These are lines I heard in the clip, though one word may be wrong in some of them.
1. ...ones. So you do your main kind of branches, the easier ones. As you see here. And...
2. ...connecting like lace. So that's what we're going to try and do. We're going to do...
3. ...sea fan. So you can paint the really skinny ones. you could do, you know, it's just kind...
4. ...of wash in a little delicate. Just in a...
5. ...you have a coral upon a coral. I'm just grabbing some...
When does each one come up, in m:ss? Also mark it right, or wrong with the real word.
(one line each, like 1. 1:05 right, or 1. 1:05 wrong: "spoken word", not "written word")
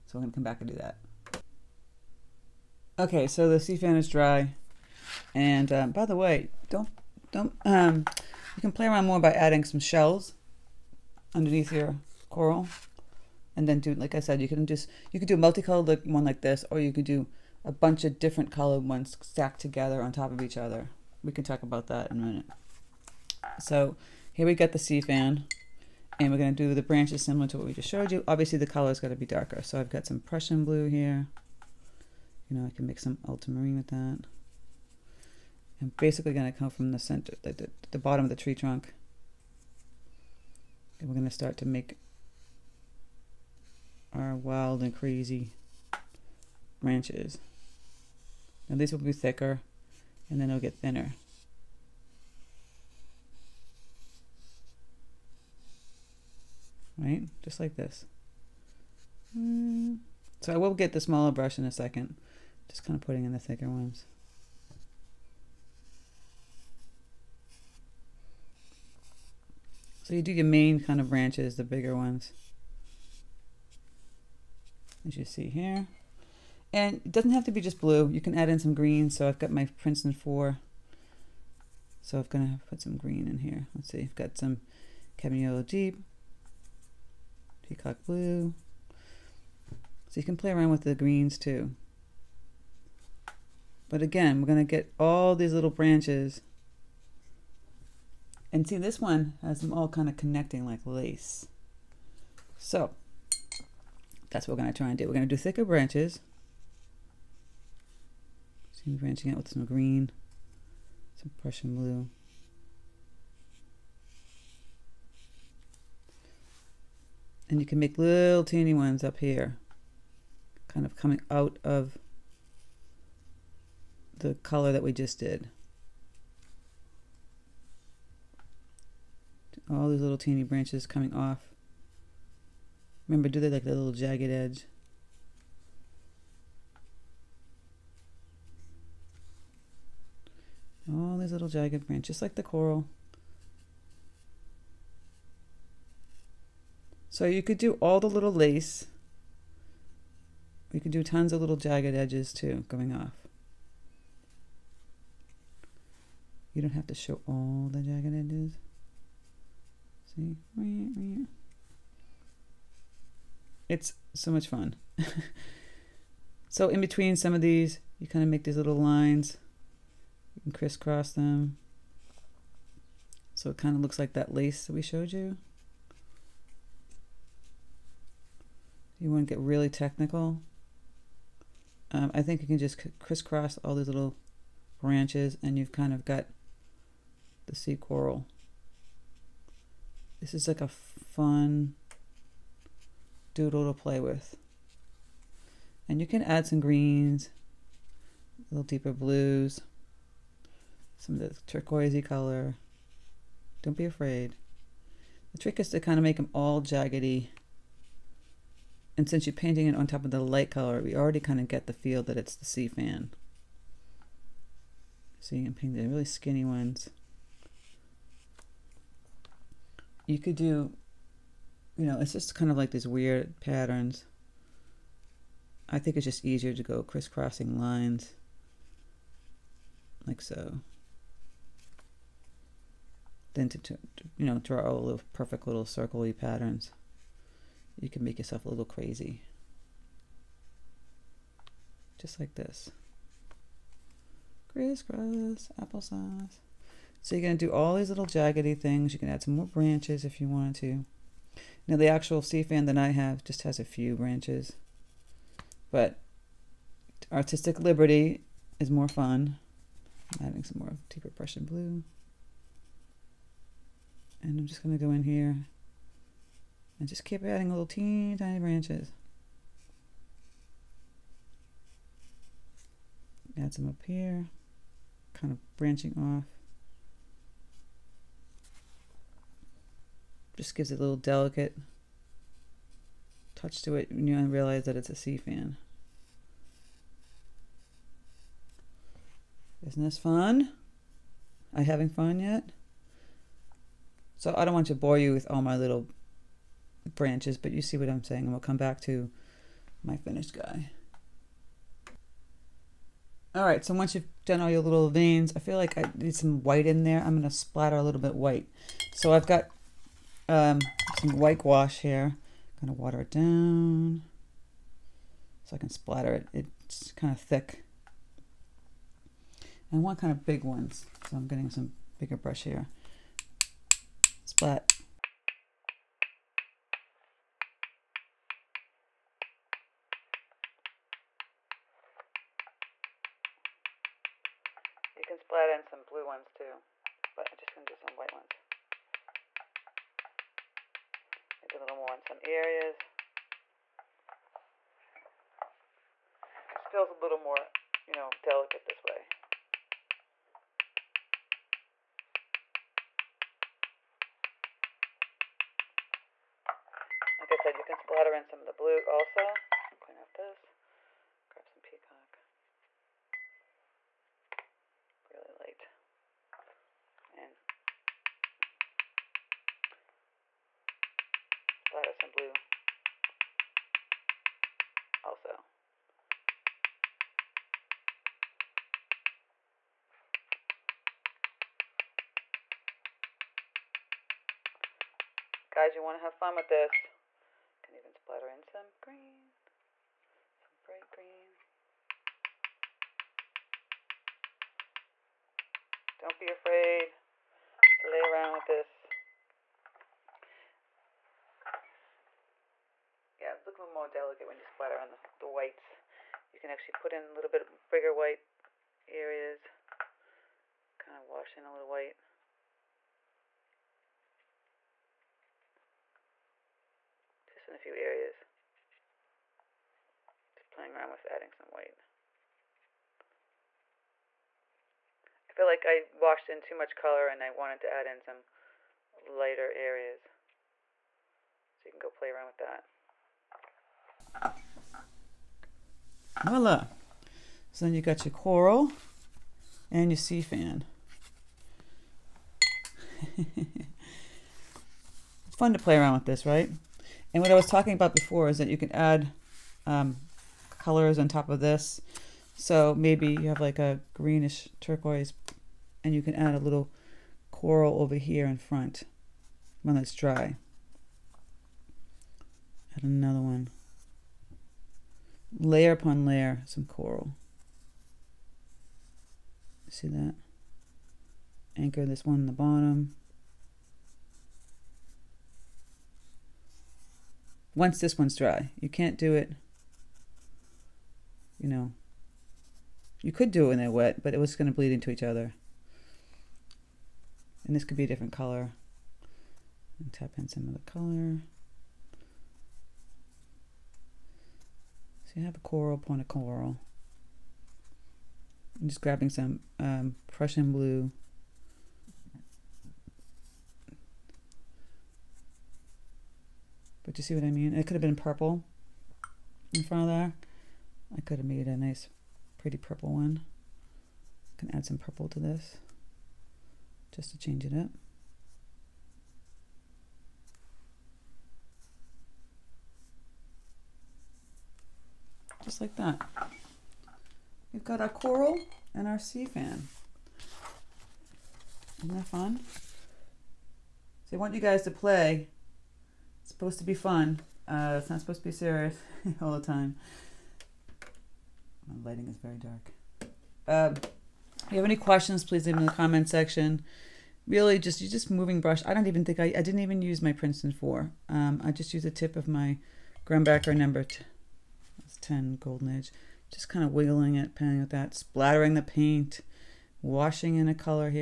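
1. 1:03 wrong: "bigger", not "easier"
2. 1:40 right
3. 3:32 right
4. 6:50 wrong: "white", not "delicate"
5. 8:15 right.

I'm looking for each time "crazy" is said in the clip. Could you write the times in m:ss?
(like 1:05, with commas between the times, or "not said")
0:44, 3:58.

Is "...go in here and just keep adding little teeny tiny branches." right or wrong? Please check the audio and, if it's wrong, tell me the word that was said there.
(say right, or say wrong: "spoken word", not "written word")
right.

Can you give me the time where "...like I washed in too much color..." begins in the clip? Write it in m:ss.
7:05.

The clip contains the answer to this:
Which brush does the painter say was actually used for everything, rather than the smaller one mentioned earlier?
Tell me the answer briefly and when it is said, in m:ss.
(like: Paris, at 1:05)
Grumbacher number 10 golden edge, at 9:13.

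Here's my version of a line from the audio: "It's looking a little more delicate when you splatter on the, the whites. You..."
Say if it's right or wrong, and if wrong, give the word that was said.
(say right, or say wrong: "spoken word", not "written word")
right.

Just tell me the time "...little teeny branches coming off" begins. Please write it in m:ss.
2:10.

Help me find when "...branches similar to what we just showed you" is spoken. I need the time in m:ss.
0:26.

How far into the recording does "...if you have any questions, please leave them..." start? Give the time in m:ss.
9:04.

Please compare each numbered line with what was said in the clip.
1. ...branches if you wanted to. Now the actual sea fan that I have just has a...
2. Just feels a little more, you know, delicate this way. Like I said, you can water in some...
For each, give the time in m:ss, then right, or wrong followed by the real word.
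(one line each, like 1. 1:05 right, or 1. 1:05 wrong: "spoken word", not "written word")
1. 4:09 right
2. 5:46 wrong: "splatter", not "water".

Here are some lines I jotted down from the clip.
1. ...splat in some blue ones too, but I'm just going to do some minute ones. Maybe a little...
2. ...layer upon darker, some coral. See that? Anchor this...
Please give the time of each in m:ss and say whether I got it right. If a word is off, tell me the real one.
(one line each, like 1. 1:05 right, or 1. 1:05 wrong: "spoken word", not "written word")
1. 5:35 wrong: "white", not "minute"
2. 7:45 wrong: "layer", not "darker".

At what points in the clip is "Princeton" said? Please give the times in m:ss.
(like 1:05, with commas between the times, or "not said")
1:19, 9:10.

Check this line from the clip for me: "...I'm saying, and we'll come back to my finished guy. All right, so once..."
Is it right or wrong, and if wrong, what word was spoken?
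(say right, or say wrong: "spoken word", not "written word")
right.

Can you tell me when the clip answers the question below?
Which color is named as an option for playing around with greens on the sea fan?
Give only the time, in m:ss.
1:25.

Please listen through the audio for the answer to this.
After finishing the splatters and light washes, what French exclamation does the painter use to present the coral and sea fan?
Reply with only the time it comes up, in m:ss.
7:16.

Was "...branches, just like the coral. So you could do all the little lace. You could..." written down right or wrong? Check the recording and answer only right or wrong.
right.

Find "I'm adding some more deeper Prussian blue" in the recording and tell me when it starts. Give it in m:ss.
4:20.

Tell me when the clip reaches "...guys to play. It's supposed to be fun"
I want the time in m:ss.
8:54.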